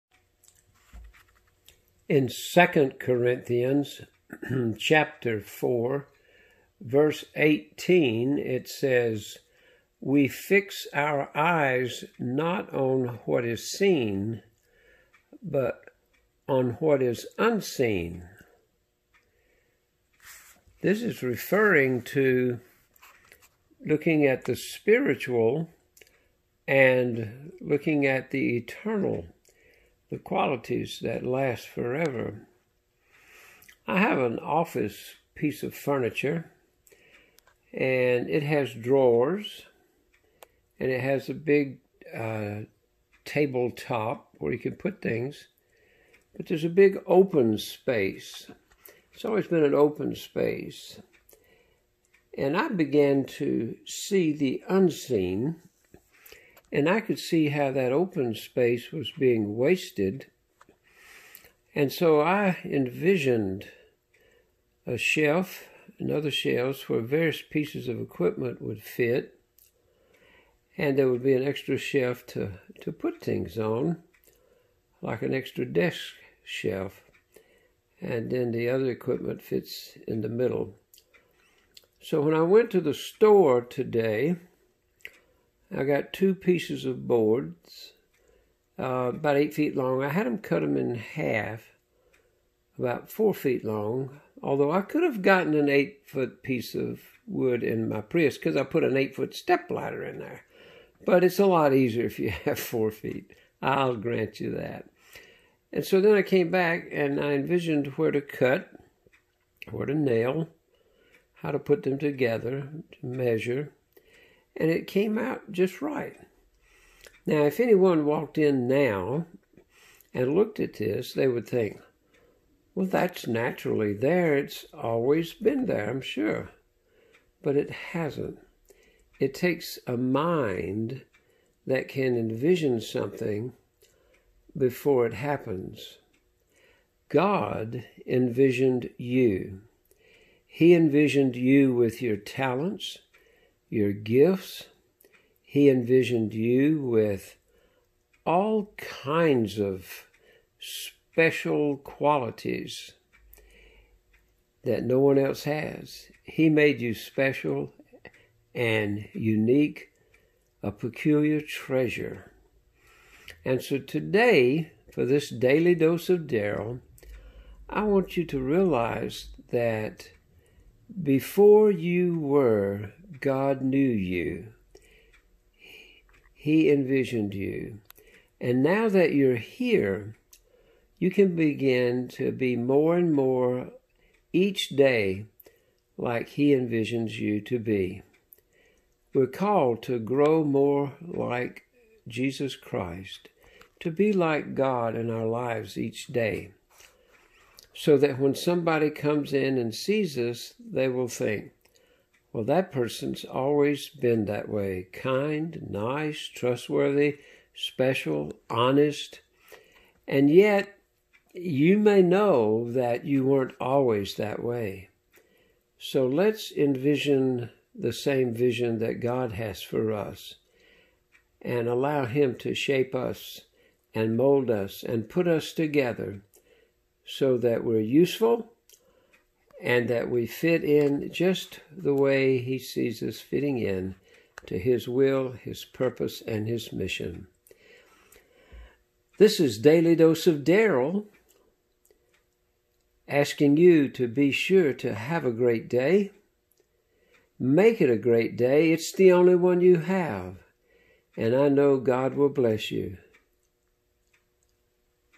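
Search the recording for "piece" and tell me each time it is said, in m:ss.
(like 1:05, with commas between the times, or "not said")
0:35, 1:07, 1:26, 1:36.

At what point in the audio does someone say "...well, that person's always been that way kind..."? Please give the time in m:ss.
3:22.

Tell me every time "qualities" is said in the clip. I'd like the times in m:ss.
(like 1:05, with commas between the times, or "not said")
0:30, 2:31.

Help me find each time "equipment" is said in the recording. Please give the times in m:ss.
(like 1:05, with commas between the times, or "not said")
1:07, 1:18.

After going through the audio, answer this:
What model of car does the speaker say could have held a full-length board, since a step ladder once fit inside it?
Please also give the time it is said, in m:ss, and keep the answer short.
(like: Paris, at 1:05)
Prius, at 1:38.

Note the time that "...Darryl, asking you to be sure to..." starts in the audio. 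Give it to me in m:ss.
4:00.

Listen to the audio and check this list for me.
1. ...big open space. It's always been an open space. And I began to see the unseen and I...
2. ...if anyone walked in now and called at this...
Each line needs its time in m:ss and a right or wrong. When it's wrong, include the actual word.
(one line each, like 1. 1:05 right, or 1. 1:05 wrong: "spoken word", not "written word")
1. 0:46 right
2. 1:57 wrong: "looked", not "called".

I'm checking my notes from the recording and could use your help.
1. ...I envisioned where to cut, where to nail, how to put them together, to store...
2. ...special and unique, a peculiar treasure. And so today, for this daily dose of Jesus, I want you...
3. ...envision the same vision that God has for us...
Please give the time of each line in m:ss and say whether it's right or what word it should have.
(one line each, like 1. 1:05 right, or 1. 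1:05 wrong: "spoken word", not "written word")
1. 1:47 wrong: "measure", not "store"
2. 2:36 wrong: "Darryl", not "Jesus"
3. 3:36 right.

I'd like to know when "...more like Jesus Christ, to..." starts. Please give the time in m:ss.
3:10.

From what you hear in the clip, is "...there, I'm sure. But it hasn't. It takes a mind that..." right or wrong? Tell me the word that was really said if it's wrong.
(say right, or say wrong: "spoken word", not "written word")
right.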